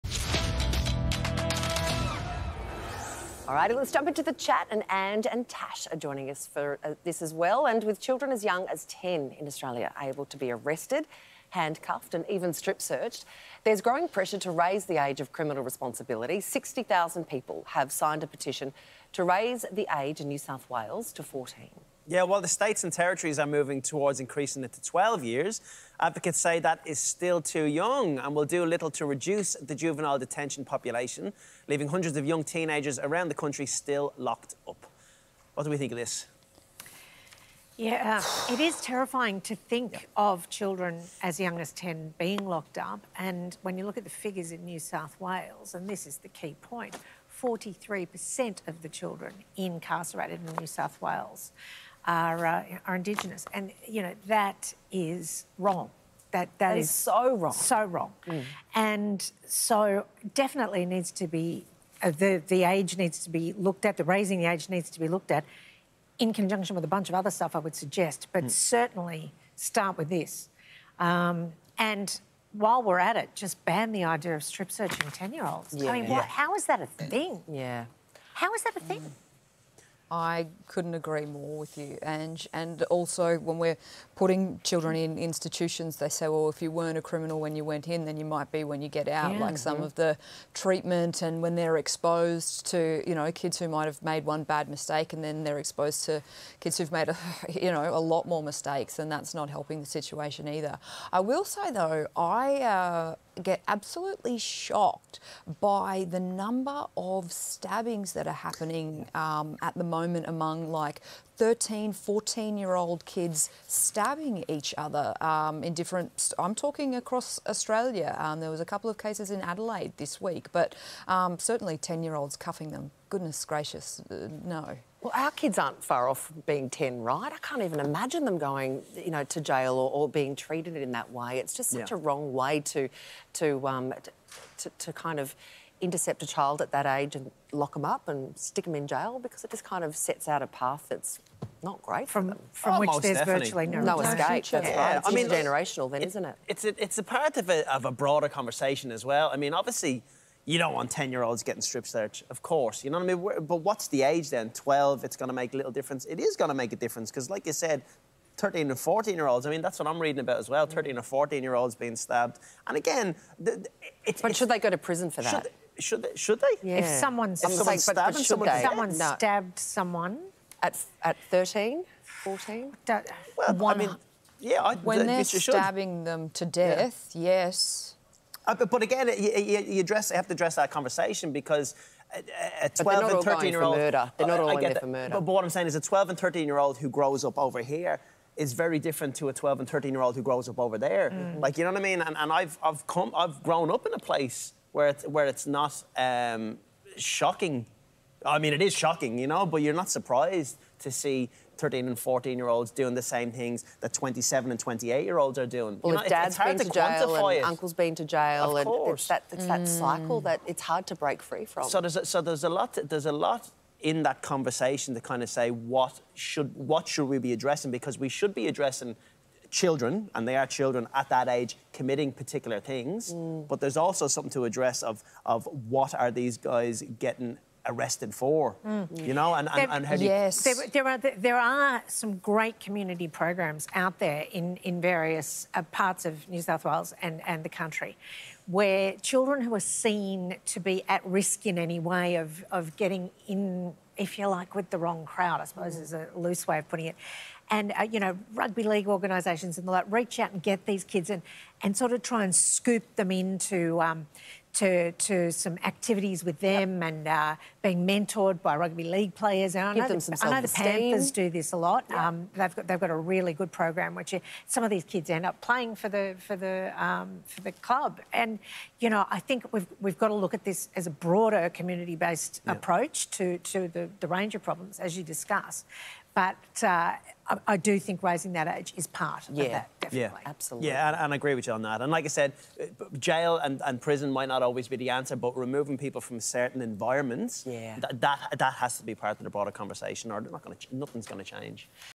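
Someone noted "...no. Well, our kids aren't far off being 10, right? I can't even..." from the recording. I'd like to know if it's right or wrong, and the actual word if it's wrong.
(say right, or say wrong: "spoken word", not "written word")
right.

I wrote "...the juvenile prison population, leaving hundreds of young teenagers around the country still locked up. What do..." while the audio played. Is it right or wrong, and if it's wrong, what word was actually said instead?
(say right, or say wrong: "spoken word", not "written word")
wrong: "detention", not "prison".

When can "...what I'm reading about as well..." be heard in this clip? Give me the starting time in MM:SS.
02:39.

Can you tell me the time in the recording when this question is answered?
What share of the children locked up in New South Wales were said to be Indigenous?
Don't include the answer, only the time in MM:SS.
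00:47.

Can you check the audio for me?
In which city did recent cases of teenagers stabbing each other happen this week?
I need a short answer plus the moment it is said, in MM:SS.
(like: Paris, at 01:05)
Adelaide, at 01:59.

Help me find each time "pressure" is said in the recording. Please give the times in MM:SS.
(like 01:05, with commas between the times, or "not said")
00:14.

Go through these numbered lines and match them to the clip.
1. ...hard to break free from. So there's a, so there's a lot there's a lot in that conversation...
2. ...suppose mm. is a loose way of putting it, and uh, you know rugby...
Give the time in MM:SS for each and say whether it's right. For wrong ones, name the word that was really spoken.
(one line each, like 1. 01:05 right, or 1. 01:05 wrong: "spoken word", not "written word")
1. 03:30 right
2. 04:05 right.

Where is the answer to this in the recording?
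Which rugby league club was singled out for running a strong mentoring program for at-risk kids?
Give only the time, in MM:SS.
04:20.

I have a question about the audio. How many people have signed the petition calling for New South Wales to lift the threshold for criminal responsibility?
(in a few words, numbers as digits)
60,000.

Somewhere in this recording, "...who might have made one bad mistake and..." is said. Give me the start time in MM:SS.
01:33.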